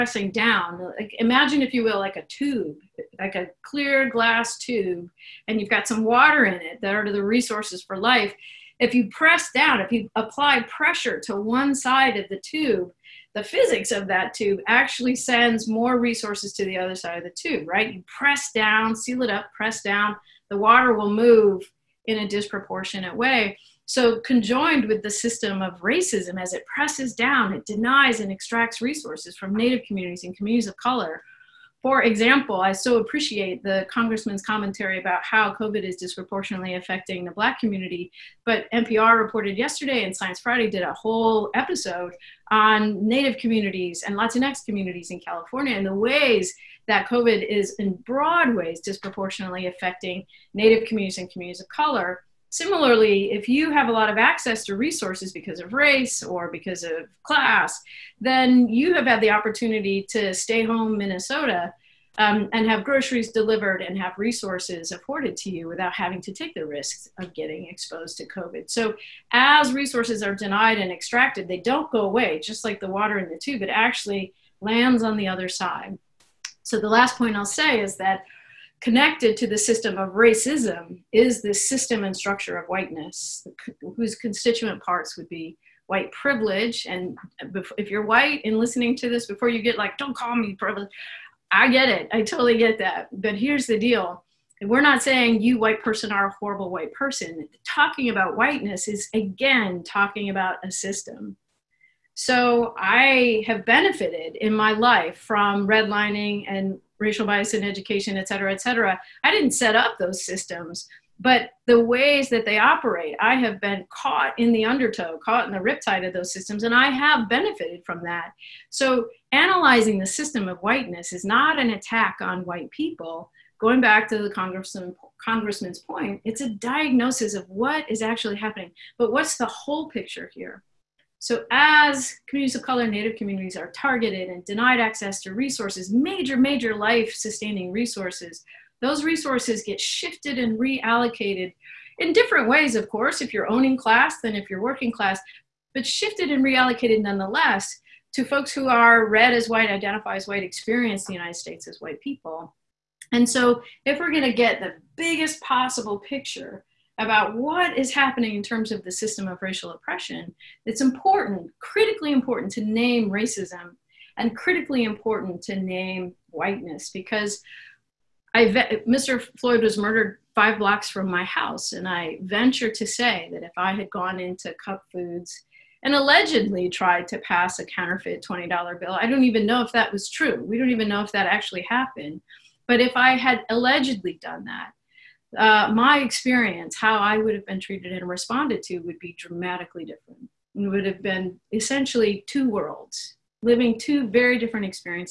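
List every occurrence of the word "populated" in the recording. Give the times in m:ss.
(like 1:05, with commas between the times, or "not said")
not said.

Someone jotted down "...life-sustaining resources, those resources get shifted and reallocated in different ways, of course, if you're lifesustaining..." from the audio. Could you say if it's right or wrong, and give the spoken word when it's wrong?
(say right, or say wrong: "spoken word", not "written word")
wrong: "owning", not "lifesustaining".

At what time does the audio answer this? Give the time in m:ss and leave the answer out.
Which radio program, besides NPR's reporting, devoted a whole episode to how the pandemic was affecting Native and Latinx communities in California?
0:40.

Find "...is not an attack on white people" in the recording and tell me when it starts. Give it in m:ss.
2:01.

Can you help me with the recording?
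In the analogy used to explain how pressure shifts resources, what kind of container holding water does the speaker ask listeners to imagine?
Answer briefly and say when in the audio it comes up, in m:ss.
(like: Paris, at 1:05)
clear glass tube, at 0:03.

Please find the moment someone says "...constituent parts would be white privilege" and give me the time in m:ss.
1:24.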